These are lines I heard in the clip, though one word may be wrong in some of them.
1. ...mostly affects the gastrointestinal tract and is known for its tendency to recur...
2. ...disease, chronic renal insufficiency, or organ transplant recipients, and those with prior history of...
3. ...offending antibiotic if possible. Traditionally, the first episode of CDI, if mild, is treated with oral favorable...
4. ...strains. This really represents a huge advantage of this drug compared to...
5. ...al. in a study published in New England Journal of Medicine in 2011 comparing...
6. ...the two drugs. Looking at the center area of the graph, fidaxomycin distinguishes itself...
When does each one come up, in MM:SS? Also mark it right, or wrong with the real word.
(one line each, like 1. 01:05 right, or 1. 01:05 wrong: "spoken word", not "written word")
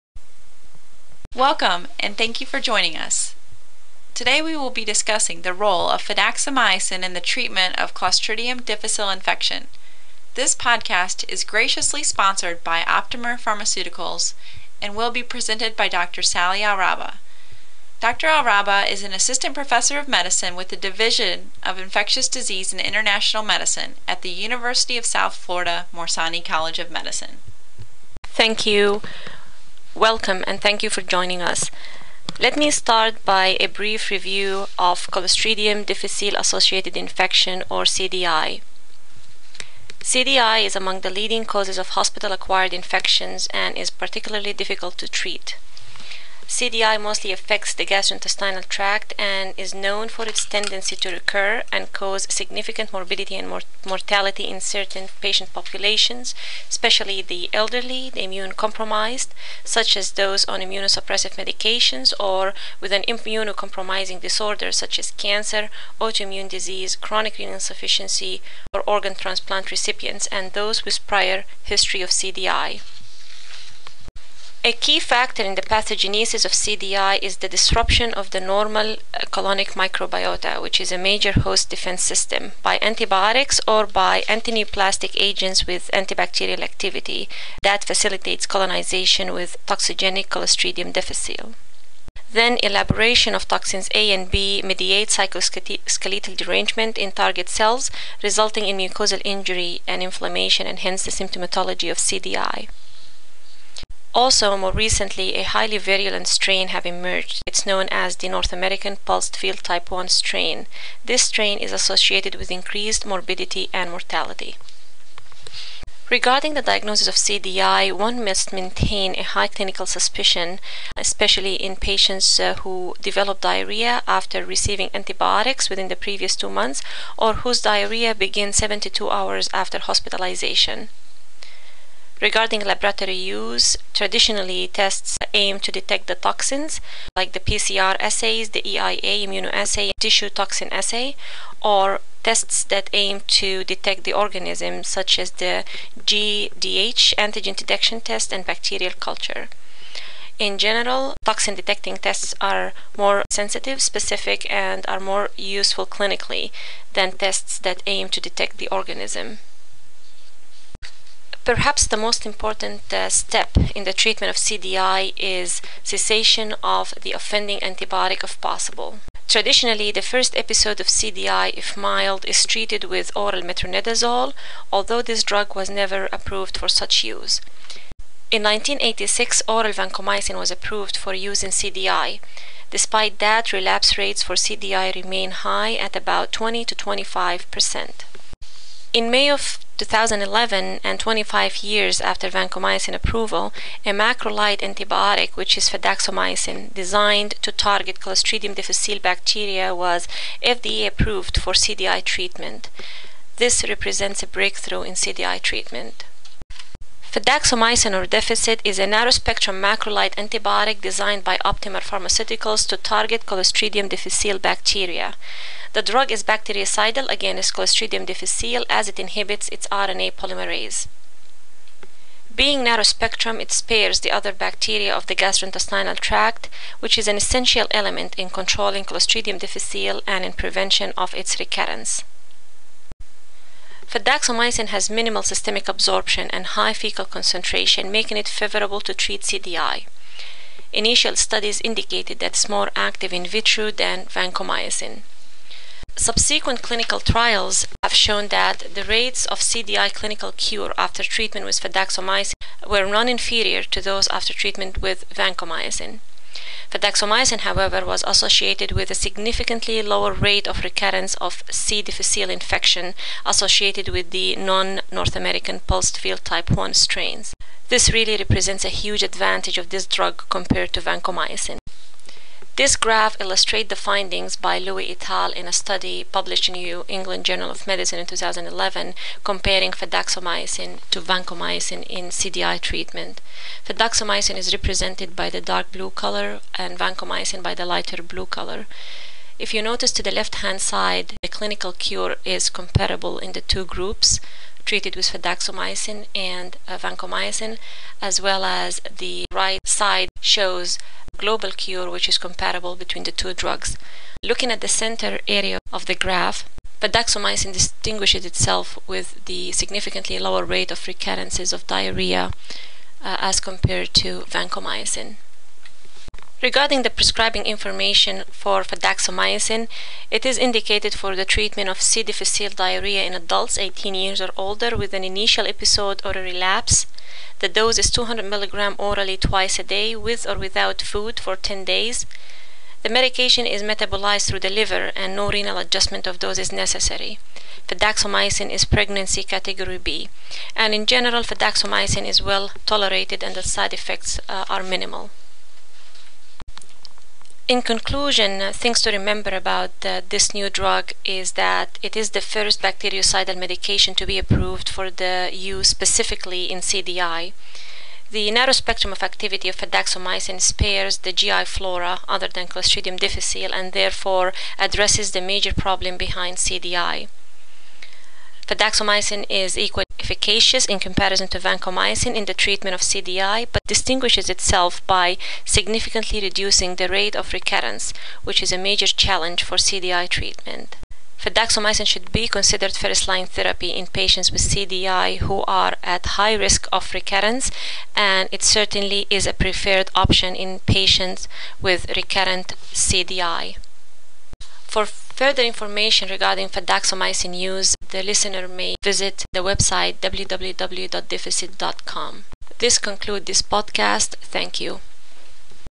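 1. 00:46 right
2. 01:06 right
3. 02:47 wrong: "metronidazole", not "favorable"
4. 04:26 right
5. 04:35 right
6. 05:03 right.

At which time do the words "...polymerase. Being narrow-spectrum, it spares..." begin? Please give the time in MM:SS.
03:40.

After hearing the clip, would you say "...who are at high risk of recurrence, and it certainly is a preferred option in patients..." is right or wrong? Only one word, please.
right.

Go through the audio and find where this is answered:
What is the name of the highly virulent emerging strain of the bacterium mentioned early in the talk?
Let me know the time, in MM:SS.
01:48.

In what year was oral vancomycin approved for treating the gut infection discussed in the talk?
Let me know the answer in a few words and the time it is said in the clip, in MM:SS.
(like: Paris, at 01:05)
1986, at 02:58.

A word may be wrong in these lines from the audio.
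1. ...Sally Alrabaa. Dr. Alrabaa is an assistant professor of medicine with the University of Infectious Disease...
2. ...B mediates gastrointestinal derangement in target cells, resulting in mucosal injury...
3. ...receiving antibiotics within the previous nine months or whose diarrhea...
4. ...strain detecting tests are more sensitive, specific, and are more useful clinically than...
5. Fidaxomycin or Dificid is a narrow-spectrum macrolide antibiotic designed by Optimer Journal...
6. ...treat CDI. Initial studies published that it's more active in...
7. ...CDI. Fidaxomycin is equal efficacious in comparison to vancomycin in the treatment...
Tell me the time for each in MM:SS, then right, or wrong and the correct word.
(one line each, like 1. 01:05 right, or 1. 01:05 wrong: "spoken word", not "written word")
1. 00:16 wrong: "Division", not "University"
2. 01:34 wrong: "cytoskeletal", not "gastrointestinal"
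3. 02:04 wrong: "two", not "nine"
4. 02:31 wrong: "toxin", not "strain"
5. 03:27 wrong: "Pharmaceuticals", not "Journal"
6. 03:58 wrong: "indicated", not "published"
7. 06:06 right.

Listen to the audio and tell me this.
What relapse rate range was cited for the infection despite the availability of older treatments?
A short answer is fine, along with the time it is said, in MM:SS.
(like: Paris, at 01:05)
20 to 25 percent, at 03:06.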